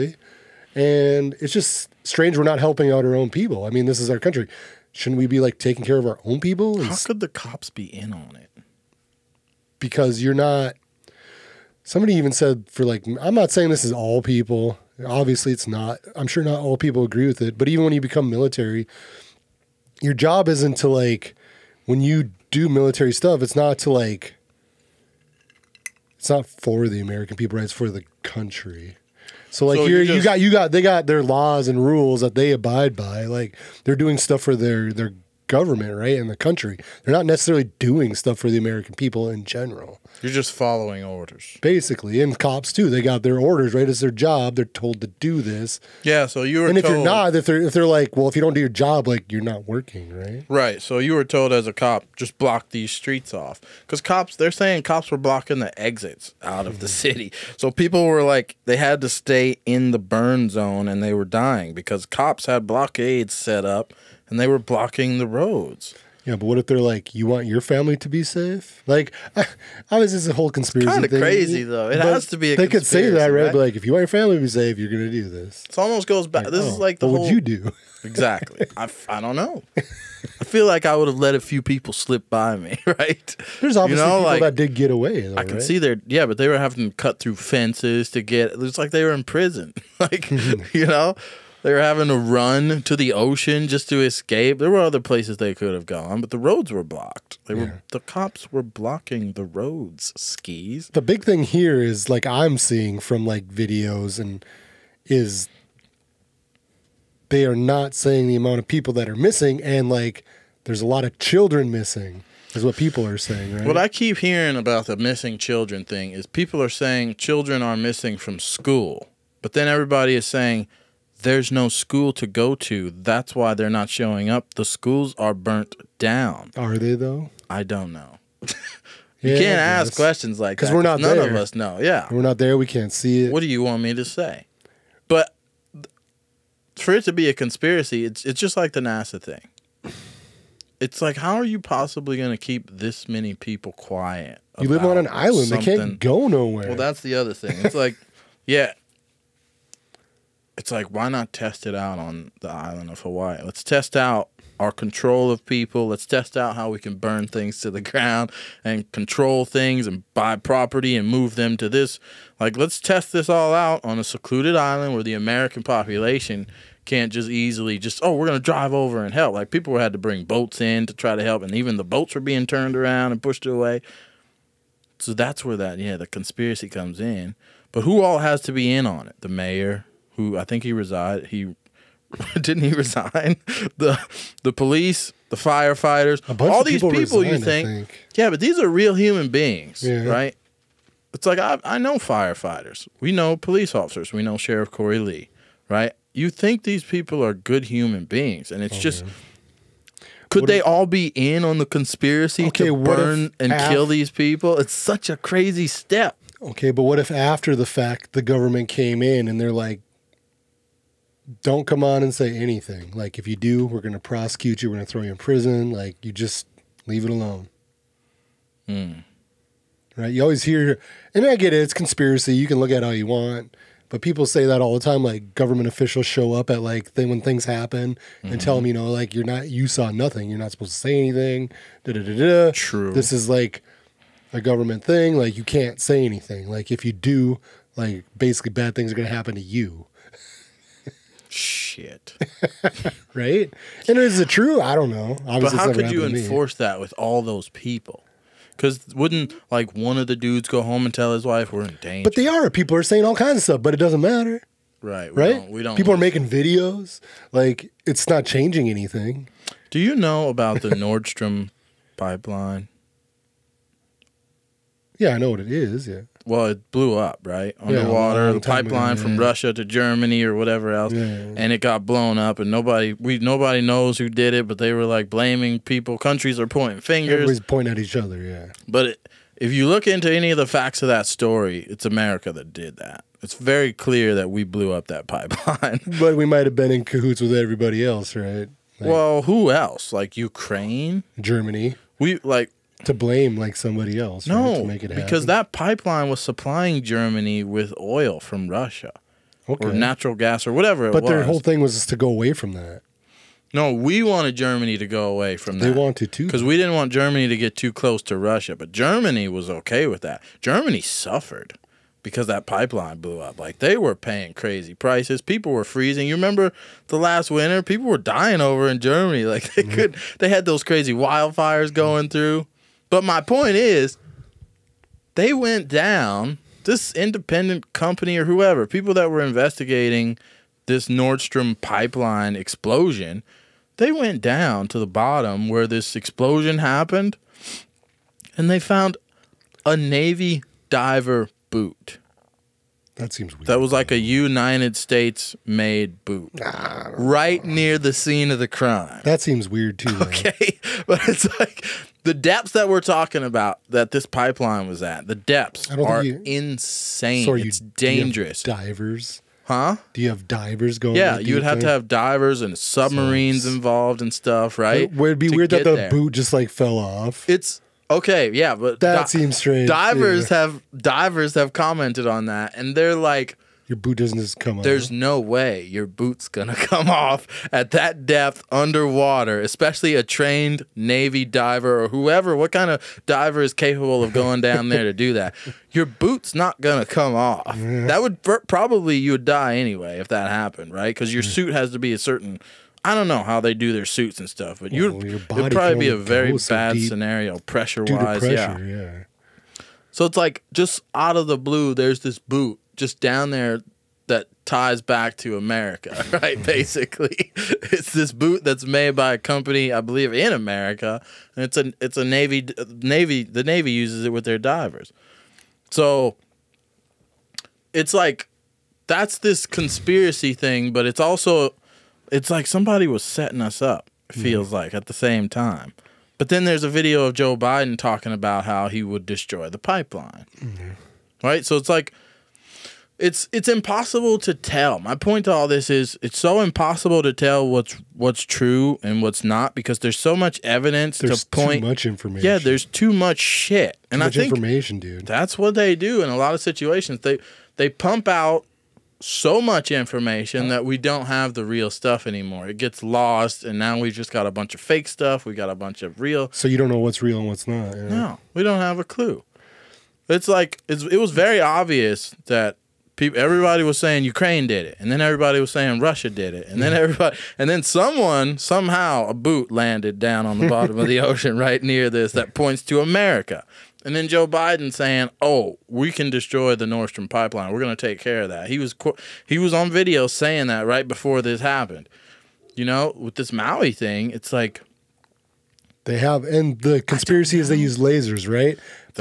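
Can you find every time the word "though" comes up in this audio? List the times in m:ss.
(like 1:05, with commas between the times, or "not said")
1:11, 1:25, 2:06.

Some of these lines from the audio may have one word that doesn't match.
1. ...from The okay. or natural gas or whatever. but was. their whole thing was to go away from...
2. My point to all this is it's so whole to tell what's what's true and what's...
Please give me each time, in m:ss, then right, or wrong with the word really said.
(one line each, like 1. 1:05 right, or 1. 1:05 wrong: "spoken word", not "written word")
1. 4:58 wrong: "Russia", not "The"
2. 7:14 wrong: "impossible", not "whole".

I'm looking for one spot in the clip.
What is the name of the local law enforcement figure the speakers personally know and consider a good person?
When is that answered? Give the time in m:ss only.
3:14.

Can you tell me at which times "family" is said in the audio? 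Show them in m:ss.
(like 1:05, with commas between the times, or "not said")
1:07, 1:14.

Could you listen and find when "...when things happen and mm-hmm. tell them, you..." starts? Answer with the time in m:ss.
3:47.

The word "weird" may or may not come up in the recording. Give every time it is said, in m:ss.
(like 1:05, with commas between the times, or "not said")
5:43, 5:49, 6:05.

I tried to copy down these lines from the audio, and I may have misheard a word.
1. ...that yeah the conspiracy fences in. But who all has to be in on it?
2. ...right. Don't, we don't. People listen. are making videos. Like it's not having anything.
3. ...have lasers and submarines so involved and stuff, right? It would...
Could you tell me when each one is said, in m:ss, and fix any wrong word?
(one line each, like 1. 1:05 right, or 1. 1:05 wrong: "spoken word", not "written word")
1. 2:55 wrong: "comes", not "fences"
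2. 4:15 wrong: "changing", not "having"
3. 6:01 wrong: "divers", not "lasers".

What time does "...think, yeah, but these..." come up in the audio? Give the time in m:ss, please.
3:07.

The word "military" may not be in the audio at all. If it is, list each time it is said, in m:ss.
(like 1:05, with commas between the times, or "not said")
0:18, 0:22.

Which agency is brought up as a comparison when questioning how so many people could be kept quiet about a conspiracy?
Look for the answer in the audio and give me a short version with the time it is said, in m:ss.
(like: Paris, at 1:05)
NASA, at 2:18.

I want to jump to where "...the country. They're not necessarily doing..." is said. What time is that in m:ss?
0:36.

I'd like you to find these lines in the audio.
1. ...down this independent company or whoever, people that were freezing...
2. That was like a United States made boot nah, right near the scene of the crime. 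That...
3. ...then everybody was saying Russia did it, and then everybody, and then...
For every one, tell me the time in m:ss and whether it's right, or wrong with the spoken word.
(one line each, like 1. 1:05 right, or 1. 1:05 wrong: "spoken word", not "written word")
1. 5:25 wrong: "investigating", not "freezing"
2. 5:43 right
3. 7:44 right.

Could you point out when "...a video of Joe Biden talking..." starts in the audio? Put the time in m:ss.
7:06.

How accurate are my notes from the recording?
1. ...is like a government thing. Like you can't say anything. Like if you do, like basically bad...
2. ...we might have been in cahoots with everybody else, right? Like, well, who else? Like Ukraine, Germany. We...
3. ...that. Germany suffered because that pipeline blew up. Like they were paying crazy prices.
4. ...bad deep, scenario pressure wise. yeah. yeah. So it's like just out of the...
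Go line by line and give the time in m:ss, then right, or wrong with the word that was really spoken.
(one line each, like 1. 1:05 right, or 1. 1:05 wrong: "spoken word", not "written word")
1. 3:53 right
2. 4:46 right
3. 5:10 right
4. 6:36 right.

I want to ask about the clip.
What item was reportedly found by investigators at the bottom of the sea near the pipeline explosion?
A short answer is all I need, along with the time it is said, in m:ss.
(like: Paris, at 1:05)
A Navy diver boot, at 5:39.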